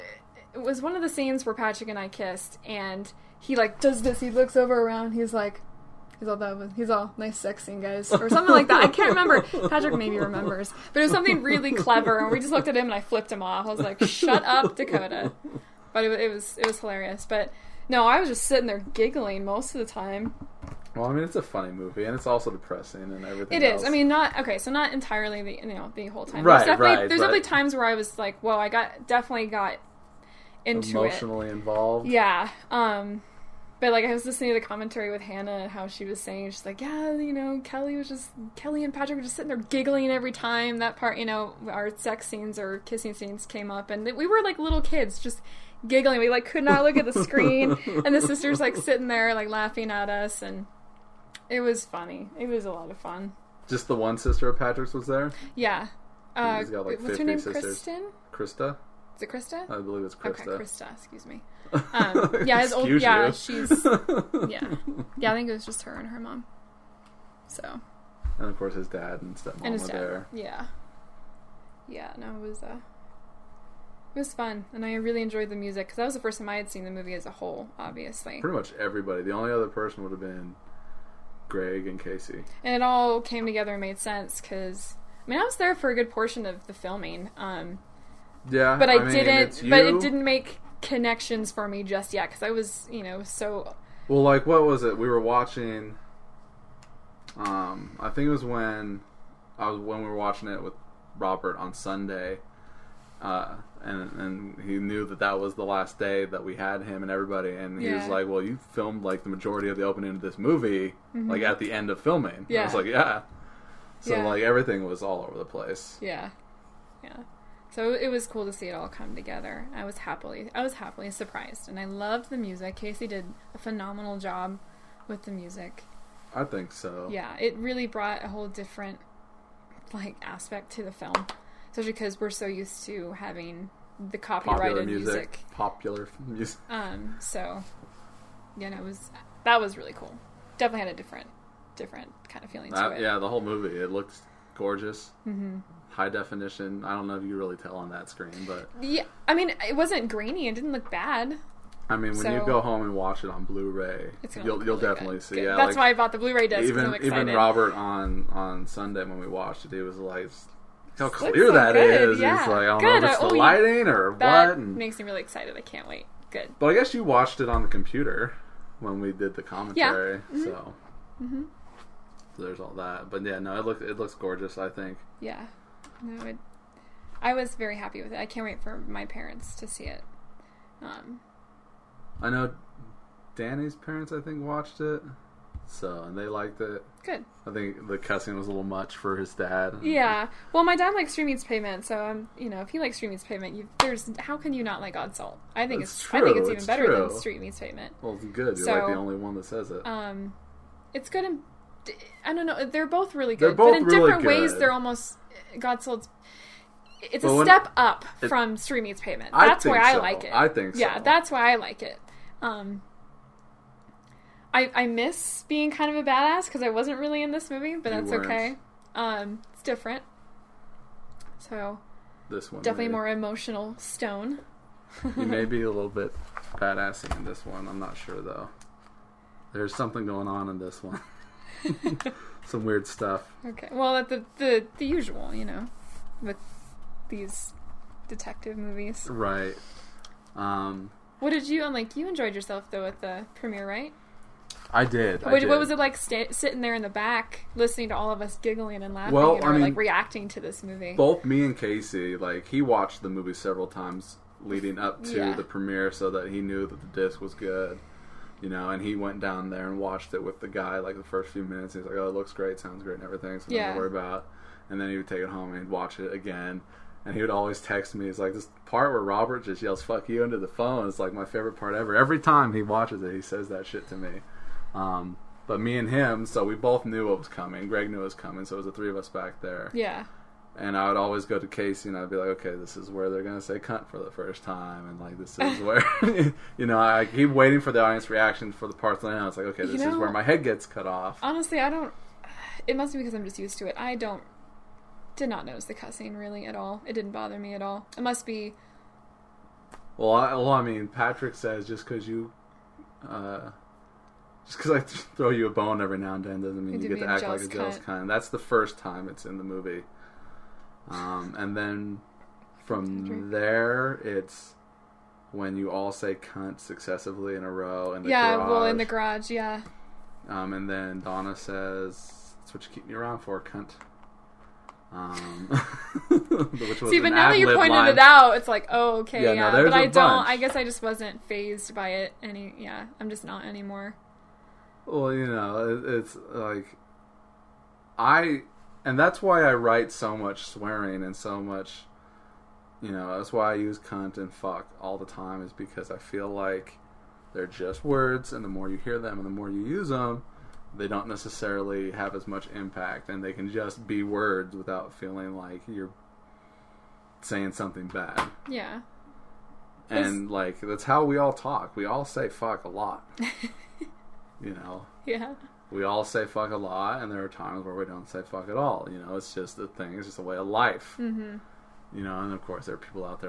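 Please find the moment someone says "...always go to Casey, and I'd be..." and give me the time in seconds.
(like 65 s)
280 s.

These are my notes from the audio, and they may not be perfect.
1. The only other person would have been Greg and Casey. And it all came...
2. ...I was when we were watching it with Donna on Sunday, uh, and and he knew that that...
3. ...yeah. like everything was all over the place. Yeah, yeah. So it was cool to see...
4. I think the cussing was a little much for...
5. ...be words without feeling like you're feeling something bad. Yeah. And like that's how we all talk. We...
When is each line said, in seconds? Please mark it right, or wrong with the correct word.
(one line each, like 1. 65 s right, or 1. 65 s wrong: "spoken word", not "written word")
1. 79 s right
2. 99 s wrong: "Robert", not "Donna"
3. 114 s right
4. 187 s right
5. 353 s wrong: "saying", not "feeling".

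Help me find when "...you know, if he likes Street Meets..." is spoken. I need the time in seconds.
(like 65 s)
192 s.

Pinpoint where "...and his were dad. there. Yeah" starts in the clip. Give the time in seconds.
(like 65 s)
69 s.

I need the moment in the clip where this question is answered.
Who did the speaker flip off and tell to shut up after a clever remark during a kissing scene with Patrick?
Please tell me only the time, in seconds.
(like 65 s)
14 s.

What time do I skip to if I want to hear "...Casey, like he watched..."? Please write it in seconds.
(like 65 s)
251 s.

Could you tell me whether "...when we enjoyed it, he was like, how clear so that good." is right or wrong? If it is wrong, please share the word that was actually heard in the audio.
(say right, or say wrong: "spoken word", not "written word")
wrong: "watched", not "enjoyed".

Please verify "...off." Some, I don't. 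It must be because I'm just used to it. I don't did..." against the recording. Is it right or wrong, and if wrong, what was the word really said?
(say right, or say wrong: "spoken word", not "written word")
wrong: "Honestly", not "Some".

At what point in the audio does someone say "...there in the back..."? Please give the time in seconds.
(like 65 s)
246 s.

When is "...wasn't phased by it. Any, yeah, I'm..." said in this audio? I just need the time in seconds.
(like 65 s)
330 s.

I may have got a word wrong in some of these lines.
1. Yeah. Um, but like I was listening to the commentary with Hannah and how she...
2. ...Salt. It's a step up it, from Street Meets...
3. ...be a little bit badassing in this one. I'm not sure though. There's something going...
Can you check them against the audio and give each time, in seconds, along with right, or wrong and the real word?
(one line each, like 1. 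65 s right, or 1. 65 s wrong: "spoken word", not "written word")
1. 32 s right
2. 205 s right
3. 225 s right.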